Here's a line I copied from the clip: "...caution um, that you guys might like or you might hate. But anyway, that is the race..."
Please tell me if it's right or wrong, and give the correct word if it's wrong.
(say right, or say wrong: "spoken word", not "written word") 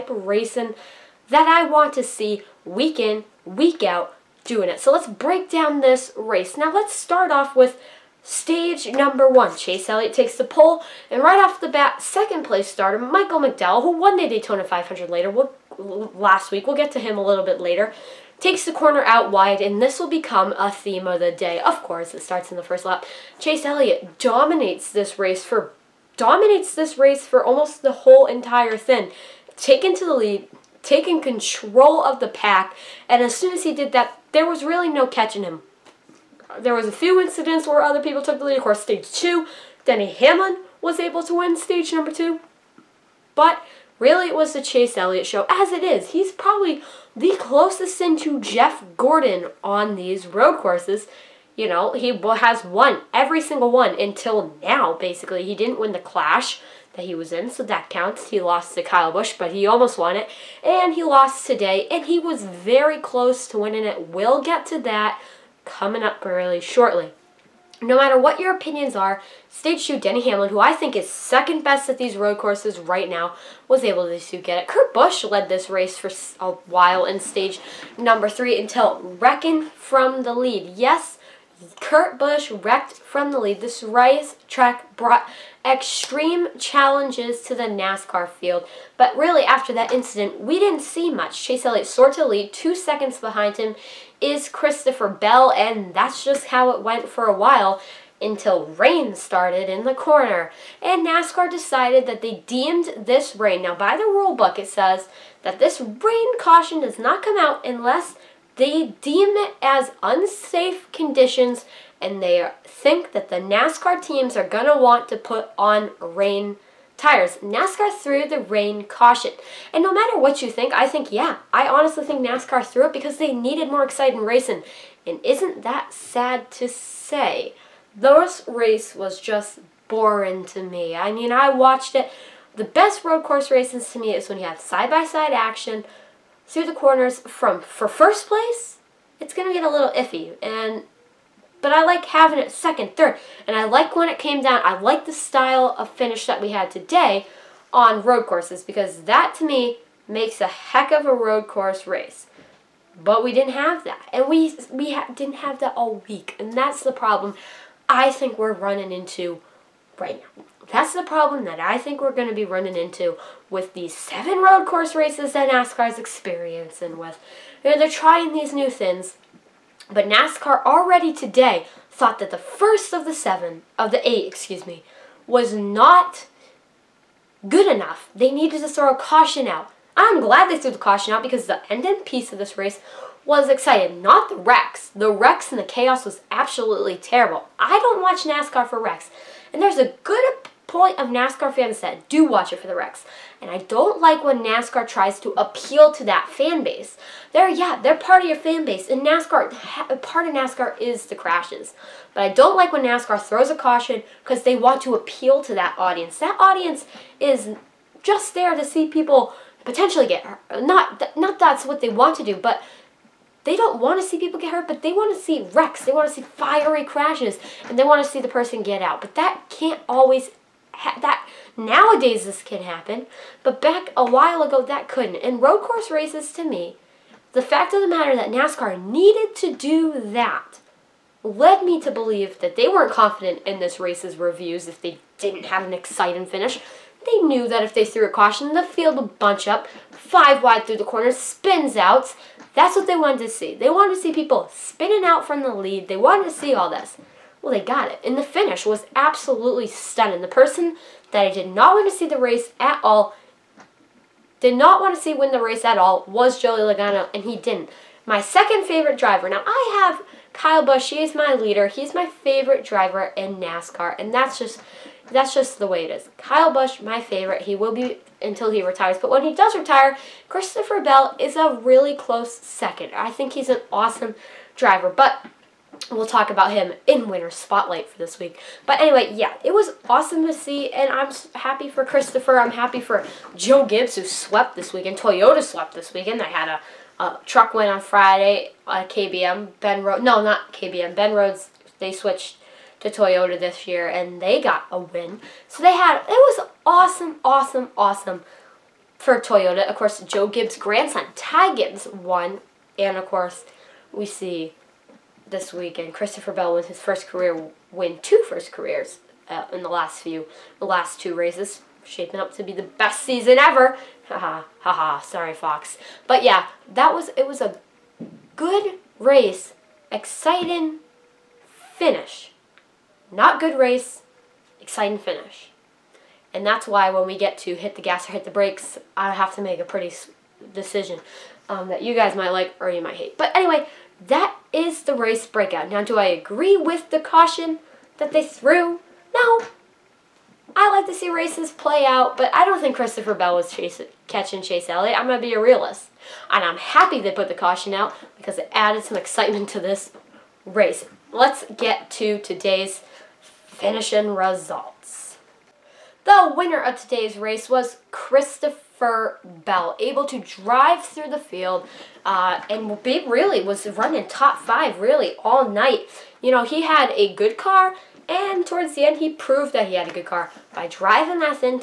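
wrong: "decision", not "caution".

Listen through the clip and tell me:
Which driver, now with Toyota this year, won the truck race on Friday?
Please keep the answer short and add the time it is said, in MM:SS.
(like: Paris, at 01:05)
Ben Rhodes, at 04:50.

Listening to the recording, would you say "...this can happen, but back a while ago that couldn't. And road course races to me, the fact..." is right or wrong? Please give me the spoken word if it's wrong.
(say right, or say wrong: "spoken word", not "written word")
right.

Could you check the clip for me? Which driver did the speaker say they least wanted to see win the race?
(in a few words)
Joey Logano.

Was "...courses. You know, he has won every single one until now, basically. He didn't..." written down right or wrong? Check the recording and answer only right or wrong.
right.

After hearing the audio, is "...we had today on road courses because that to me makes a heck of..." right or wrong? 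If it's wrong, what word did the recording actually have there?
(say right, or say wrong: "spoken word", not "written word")
right.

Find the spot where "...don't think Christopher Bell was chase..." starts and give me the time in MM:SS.
05:42.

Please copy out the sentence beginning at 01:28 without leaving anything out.
But really, after that incident, we didn't see much.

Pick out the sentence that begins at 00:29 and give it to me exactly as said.
Taken to the lead, taken control of the pack, and as soon as he did that, there was really no catching him.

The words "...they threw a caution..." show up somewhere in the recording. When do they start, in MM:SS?
03:57.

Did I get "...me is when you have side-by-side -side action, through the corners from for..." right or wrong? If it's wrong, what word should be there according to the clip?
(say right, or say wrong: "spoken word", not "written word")
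right.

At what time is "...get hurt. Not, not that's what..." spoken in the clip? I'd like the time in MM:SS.
03:30.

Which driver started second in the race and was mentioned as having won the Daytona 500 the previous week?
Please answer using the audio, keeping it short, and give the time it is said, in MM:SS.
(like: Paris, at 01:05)
Michael McDowell, at 00:12.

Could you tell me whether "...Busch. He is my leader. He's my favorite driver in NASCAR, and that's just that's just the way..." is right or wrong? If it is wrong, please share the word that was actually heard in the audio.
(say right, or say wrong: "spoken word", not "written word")
right.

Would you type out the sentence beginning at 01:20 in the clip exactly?
Yes, Kurt Busch wrecked from the lead.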